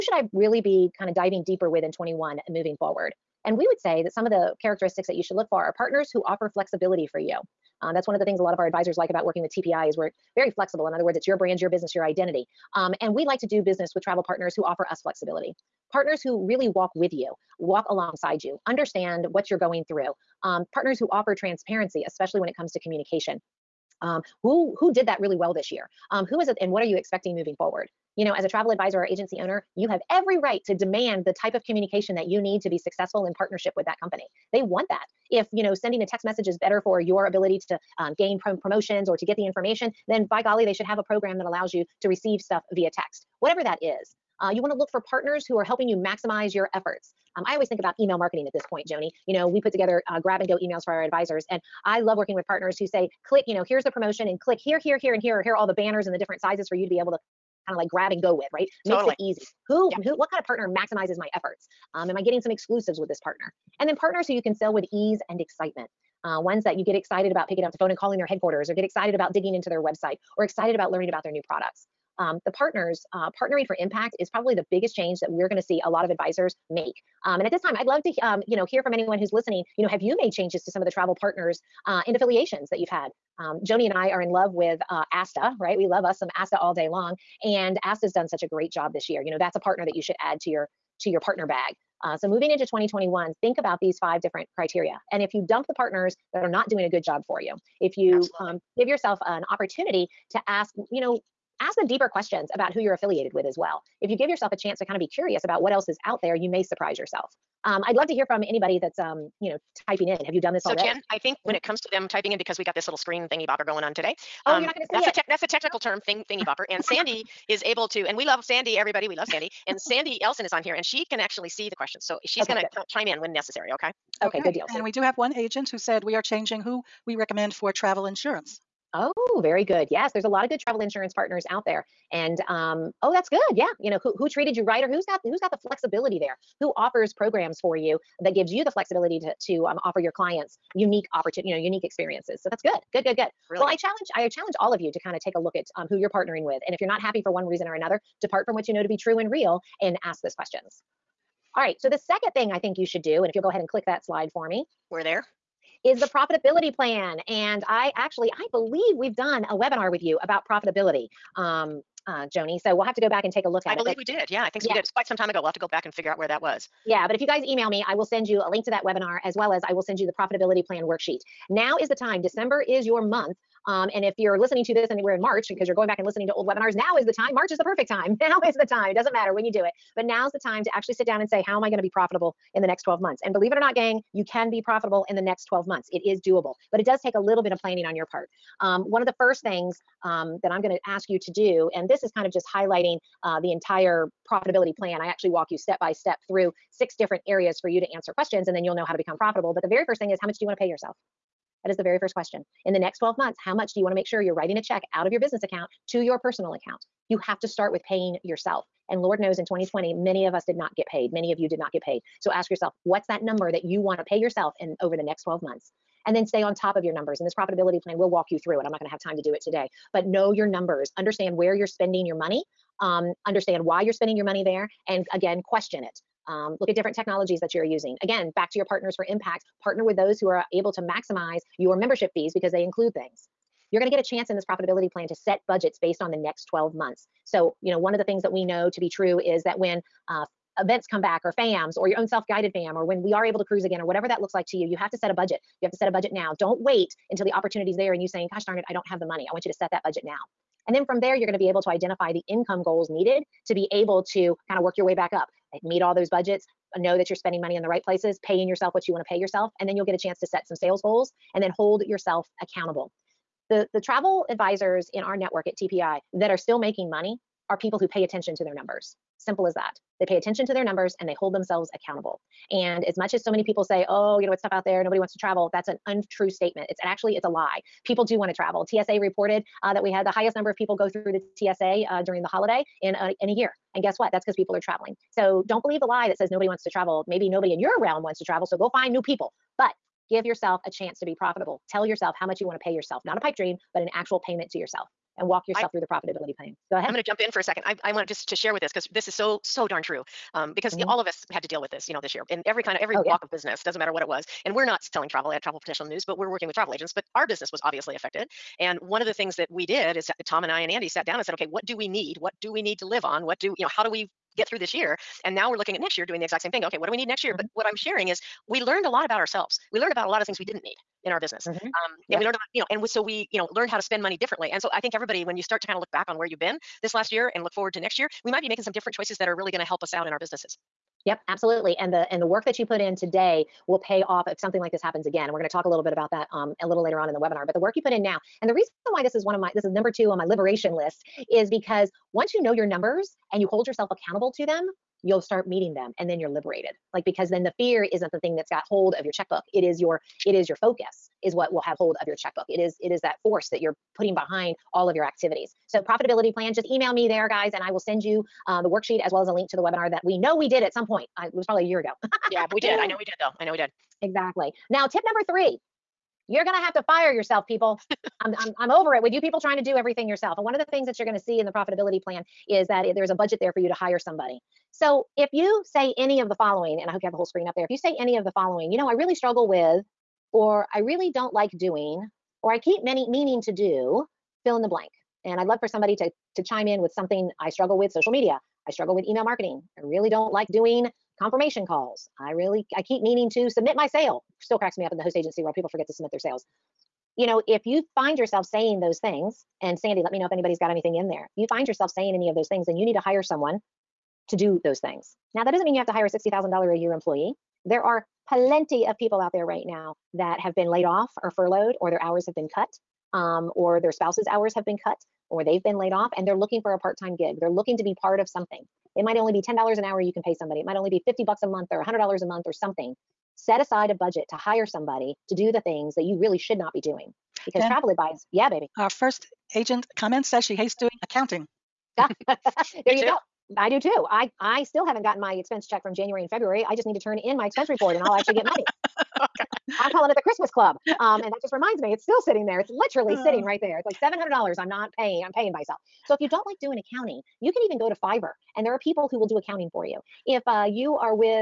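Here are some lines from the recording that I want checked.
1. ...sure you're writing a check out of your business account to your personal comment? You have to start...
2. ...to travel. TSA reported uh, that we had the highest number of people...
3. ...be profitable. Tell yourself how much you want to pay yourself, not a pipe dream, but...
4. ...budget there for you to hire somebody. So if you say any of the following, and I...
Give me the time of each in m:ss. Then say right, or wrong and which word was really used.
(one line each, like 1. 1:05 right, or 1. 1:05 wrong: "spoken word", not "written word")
1. 3:24 wrong: "account", not "comment"
2. 4:38 right
3. 4:51 right
4. 6:13 right.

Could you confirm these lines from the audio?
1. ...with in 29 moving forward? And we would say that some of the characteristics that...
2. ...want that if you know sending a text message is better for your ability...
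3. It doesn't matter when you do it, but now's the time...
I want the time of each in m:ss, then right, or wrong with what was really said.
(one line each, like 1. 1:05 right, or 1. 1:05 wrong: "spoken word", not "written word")
1. 0:01 wrong: "21", not "29"
2. 0:34 right
3. 2:58 right.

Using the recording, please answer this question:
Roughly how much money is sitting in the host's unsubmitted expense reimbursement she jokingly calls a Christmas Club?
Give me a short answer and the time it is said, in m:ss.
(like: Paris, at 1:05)
$700, at 7:24.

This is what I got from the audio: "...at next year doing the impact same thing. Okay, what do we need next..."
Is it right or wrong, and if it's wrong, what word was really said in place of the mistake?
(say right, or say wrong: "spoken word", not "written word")
wrong: "exact", not "impact".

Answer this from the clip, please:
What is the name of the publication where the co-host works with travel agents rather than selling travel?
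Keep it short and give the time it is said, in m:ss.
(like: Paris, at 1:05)
Travel Professional News, at 5:05.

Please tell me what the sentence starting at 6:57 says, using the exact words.
They're looking to be part of something.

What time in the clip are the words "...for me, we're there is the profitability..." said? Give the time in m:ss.
2:34.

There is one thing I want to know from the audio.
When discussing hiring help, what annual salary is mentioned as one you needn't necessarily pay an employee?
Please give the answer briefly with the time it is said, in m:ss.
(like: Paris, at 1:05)
$60,000, at 6:46.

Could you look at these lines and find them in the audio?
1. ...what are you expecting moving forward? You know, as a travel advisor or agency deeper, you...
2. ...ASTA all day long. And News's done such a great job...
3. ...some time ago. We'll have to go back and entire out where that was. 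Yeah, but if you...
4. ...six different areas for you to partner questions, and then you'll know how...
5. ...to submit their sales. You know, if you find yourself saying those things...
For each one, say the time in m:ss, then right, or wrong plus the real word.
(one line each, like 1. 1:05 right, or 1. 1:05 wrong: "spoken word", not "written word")
1. 0:26 wrong: "owner", not "deeper"
2. 1:26 wrong: "ASTA", not "News"
3. 2:45 wrong: "figure", not "entire"
4. 3:16 wrong: "answer", not "partner"
5. 6:35 right.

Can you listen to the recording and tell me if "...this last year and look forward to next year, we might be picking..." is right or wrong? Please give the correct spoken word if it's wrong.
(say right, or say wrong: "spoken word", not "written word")
wrong: "making", not "picking".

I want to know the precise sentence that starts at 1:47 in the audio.
Um, I'd love to hear from anybody that's, um, you know, typing in.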